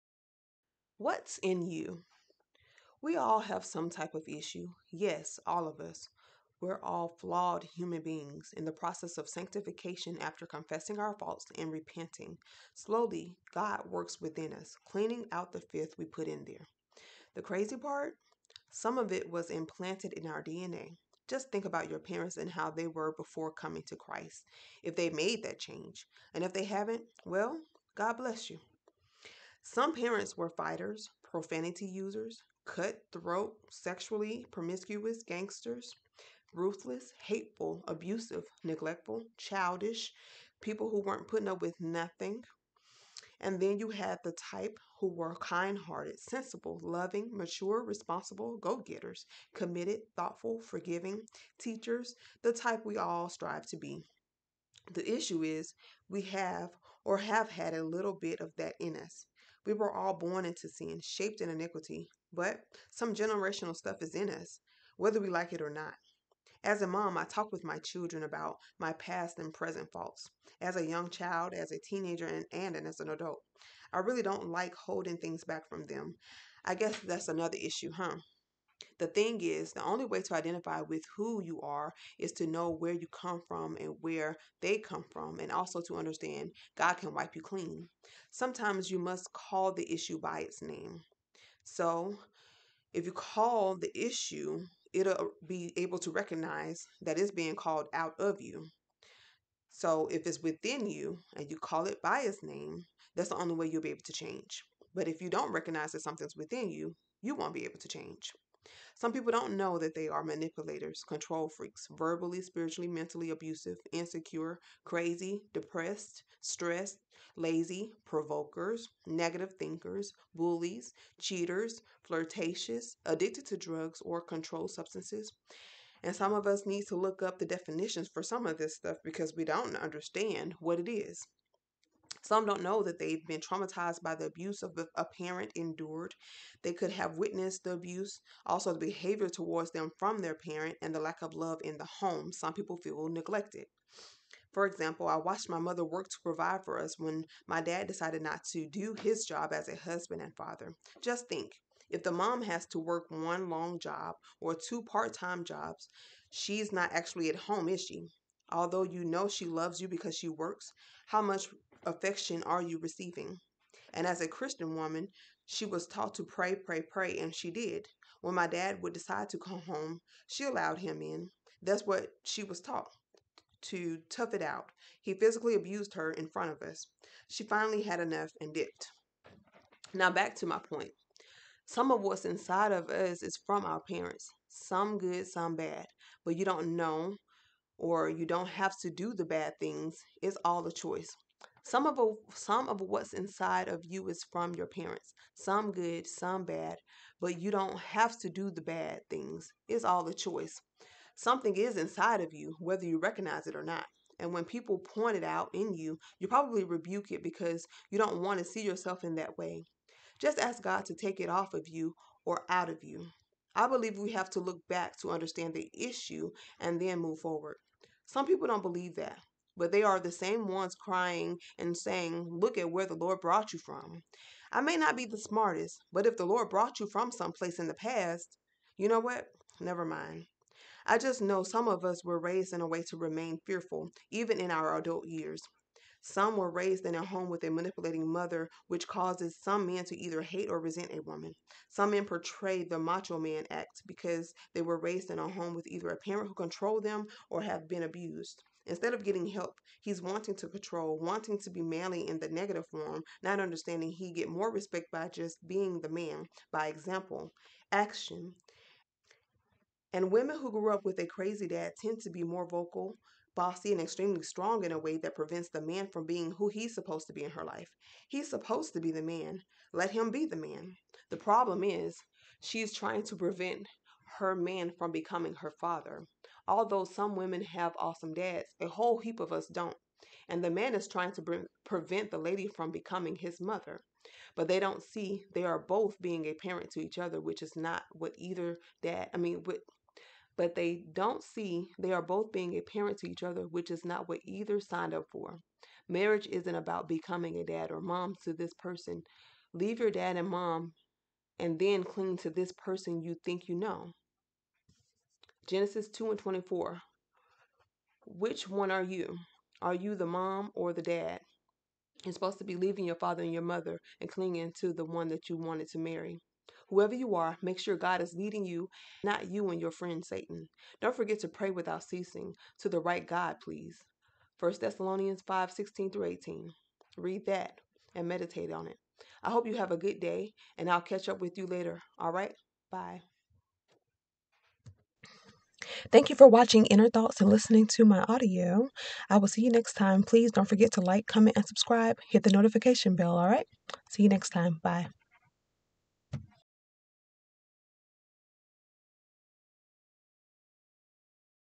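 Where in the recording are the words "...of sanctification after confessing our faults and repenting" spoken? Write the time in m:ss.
0:09.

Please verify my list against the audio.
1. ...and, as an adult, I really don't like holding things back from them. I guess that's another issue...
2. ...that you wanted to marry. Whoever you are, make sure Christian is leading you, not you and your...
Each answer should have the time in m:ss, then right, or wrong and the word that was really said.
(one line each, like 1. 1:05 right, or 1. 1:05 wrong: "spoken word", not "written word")
1. 1:12 right
2. 5:15 wrong: "God", not "Christian".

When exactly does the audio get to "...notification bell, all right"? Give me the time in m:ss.
5:42.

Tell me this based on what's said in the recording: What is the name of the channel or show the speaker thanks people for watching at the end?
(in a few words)
Inner Thoughts.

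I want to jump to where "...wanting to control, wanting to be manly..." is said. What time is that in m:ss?
4:10.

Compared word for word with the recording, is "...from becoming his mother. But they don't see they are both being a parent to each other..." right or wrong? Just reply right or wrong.
right.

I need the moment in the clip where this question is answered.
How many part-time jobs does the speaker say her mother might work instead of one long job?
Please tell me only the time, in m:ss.
2:34.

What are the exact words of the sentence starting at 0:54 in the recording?
The issue is we have or have had a little bit of that in us.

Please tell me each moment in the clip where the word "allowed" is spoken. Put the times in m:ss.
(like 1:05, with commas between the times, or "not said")
2:50.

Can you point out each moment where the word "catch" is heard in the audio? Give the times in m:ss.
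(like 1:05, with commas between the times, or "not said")
5:30.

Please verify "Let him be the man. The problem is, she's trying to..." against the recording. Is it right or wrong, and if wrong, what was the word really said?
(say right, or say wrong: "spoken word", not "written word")
right.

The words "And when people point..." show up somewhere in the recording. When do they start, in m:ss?
3:24.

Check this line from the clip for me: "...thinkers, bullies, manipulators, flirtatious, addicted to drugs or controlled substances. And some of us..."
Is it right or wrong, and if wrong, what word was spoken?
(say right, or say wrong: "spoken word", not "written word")
wrong: "cheaters", not "manipulators".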